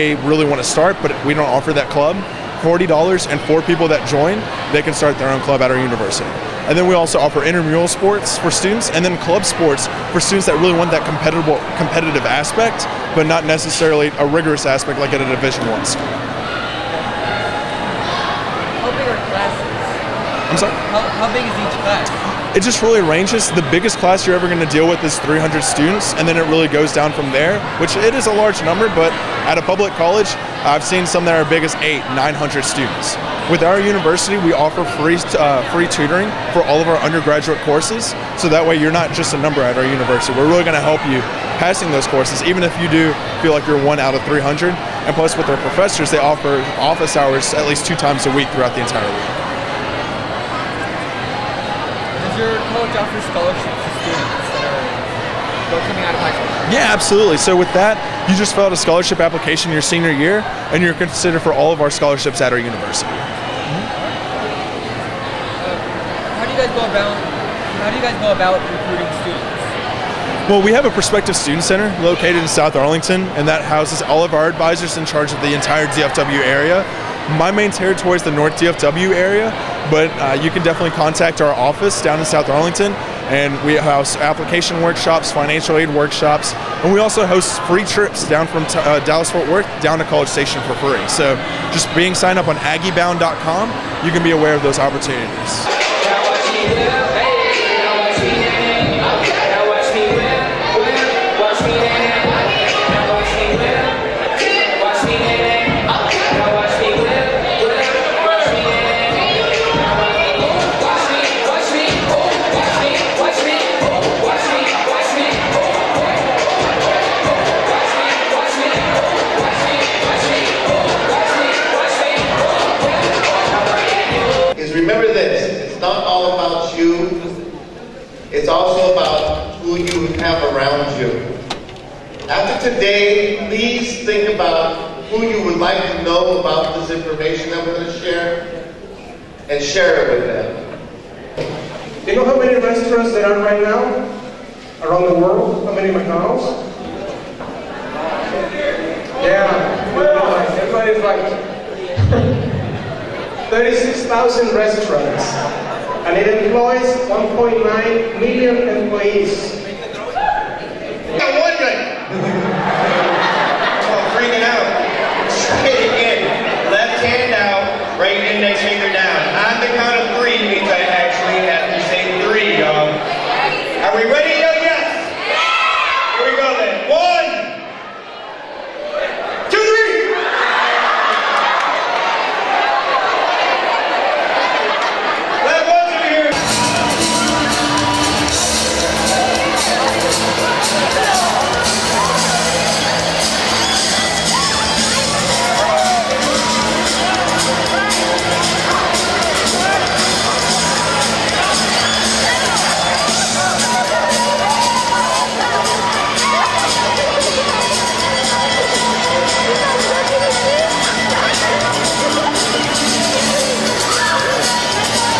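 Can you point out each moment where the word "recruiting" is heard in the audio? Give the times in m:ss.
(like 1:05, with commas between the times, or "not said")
1:08.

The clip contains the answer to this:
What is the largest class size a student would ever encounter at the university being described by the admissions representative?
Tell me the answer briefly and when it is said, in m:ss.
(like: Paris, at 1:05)
300 students, at 0:25.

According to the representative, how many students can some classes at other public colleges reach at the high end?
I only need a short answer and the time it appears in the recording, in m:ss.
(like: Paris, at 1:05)
900, at 0:32.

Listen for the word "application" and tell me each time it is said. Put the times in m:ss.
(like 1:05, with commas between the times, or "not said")
0:59, 1:24.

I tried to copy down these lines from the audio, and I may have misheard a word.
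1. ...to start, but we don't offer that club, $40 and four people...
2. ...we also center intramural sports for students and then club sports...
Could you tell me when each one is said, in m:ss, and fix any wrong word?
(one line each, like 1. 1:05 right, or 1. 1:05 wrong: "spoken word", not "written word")
1. 0:00 right
2. 0:06 wrong: "offer", not "center".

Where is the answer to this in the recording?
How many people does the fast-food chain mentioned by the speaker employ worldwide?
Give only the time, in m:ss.
2:37.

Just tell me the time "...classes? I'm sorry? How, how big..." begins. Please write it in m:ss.
0:19.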